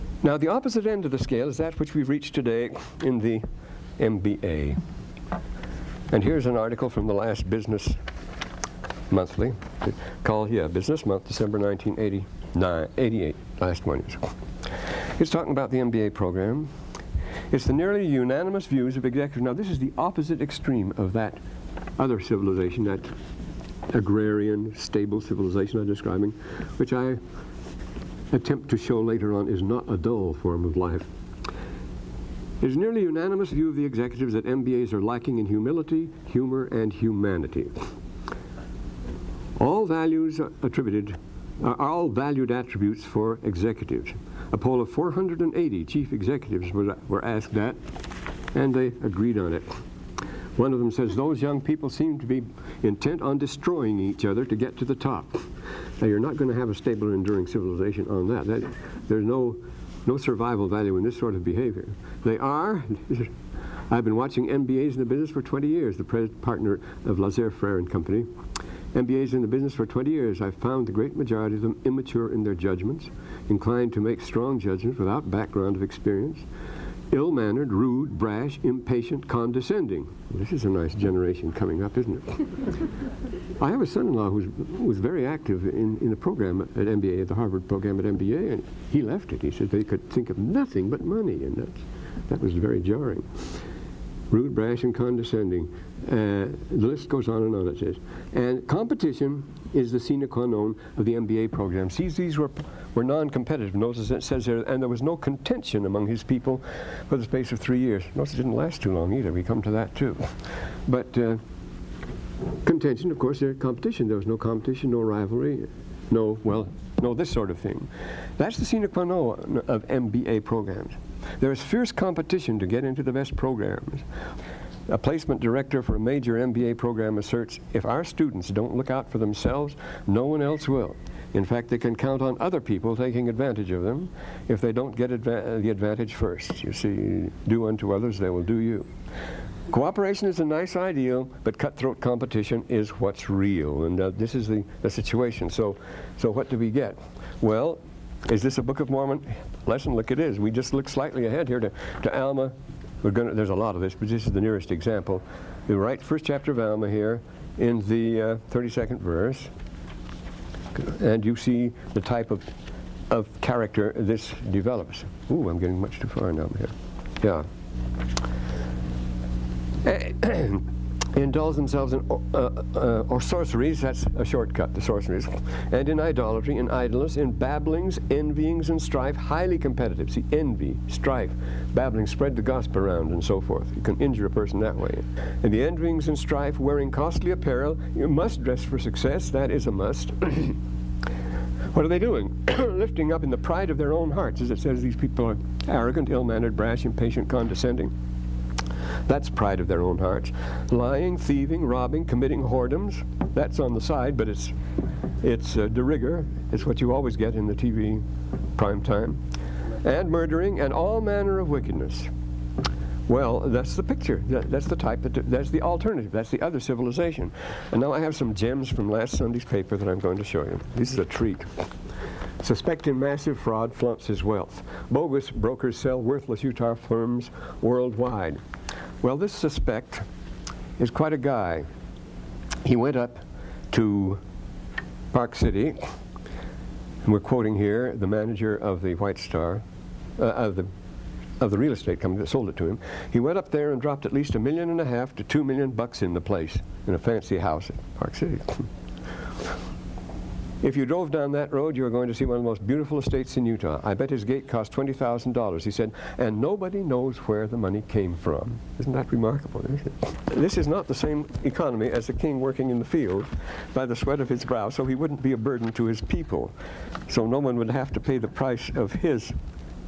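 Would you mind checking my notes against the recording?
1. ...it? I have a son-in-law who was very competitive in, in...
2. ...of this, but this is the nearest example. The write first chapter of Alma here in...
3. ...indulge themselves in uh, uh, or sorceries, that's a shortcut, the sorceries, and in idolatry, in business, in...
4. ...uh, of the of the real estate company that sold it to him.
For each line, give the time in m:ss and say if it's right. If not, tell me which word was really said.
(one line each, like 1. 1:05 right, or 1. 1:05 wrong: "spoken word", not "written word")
1. 1:22 wrong: "active", not "competitive"
2. 2:33 right
3. 2:51 wrong: "idleness", not "business"
4. 4:00 right.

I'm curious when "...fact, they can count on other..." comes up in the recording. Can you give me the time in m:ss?
2:11.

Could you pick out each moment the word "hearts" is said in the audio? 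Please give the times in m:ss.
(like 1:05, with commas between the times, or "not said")
3:14, 3:19.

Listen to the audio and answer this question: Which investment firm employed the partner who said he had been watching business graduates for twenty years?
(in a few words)
Lazard Frères.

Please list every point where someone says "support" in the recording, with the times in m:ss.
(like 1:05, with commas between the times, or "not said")
not said.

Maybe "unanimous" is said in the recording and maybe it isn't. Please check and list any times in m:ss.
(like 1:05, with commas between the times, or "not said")
0:18, 0:33.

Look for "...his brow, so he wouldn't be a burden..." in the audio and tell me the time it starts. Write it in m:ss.
4:24.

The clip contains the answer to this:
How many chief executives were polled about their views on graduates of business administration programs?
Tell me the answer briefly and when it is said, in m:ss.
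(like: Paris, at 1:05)
480, at 0:44.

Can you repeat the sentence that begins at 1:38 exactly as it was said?
And competition is the sine qua non of the MBA program.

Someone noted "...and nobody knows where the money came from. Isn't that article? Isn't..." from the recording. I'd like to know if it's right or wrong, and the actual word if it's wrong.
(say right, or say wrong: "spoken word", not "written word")
wrong: "remarkable", not "article".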